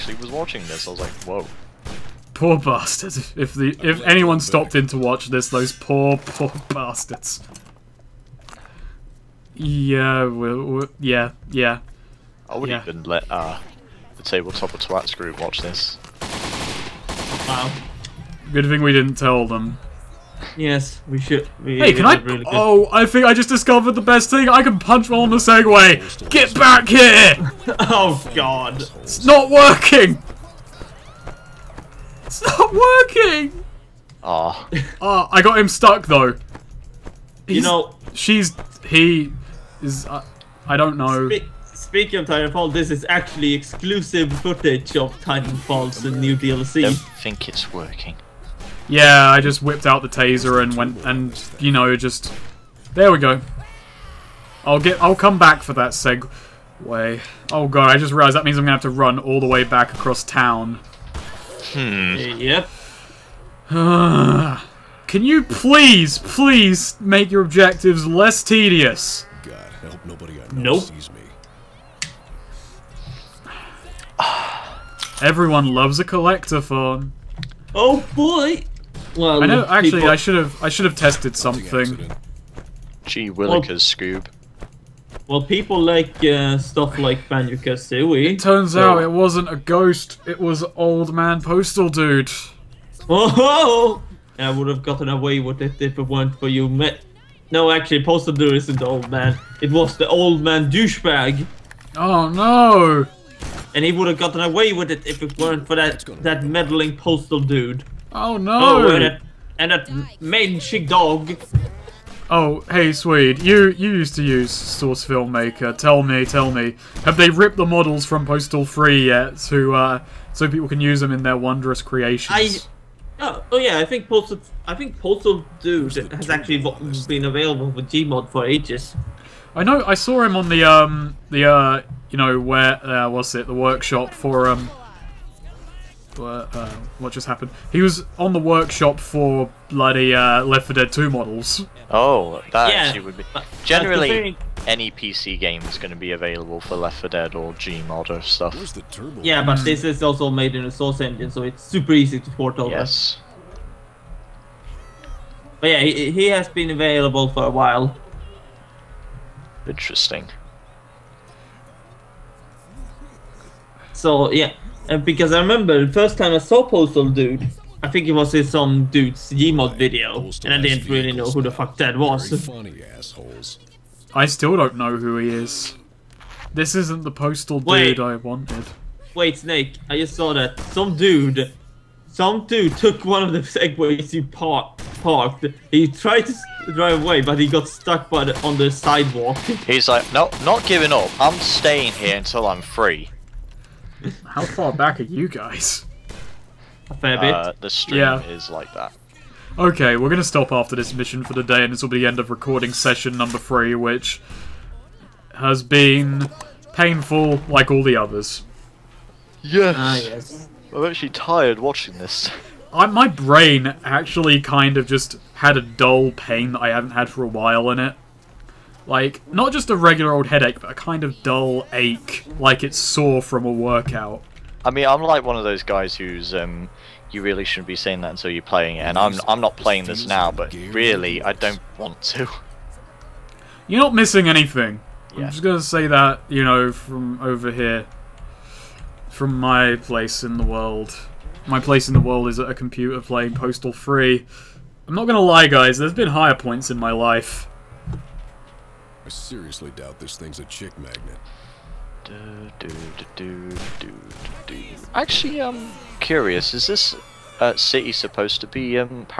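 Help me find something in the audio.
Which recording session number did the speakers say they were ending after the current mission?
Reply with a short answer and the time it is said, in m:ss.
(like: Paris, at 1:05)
3, at 3:22.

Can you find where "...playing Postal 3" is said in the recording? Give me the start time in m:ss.
4:02.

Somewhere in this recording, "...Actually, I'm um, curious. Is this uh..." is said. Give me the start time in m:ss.
4:14.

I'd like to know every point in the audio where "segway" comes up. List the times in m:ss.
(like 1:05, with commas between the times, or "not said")
0:25, 3:03.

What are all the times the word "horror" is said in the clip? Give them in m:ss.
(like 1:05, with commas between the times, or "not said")
not said.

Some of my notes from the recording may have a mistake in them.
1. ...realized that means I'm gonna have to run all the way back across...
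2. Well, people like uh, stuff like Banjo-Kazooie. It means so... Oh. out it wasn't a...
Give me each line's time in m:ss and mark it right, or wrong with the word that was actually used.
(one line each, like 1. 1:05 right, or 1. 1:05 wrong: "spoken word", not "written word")
1. 0:58 right
2. 1:25 wrong: "turns", not "means".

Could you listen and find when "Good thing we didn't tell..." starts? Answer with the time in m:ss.
0:18.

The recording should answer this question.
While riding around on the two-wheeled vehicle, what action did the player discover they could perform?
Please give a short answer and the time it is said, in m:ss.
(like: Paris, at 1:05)
Punch, at 0:24.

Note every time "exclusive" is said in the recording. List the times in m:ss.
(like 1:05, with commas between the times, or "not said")
0:43.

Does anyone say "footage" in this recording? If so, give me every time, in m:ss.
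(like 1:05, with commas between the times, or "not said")
0:44.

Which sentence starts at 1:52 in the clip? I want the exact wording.
Oh, hey, Swede, you, you used to use Source Filmmaker.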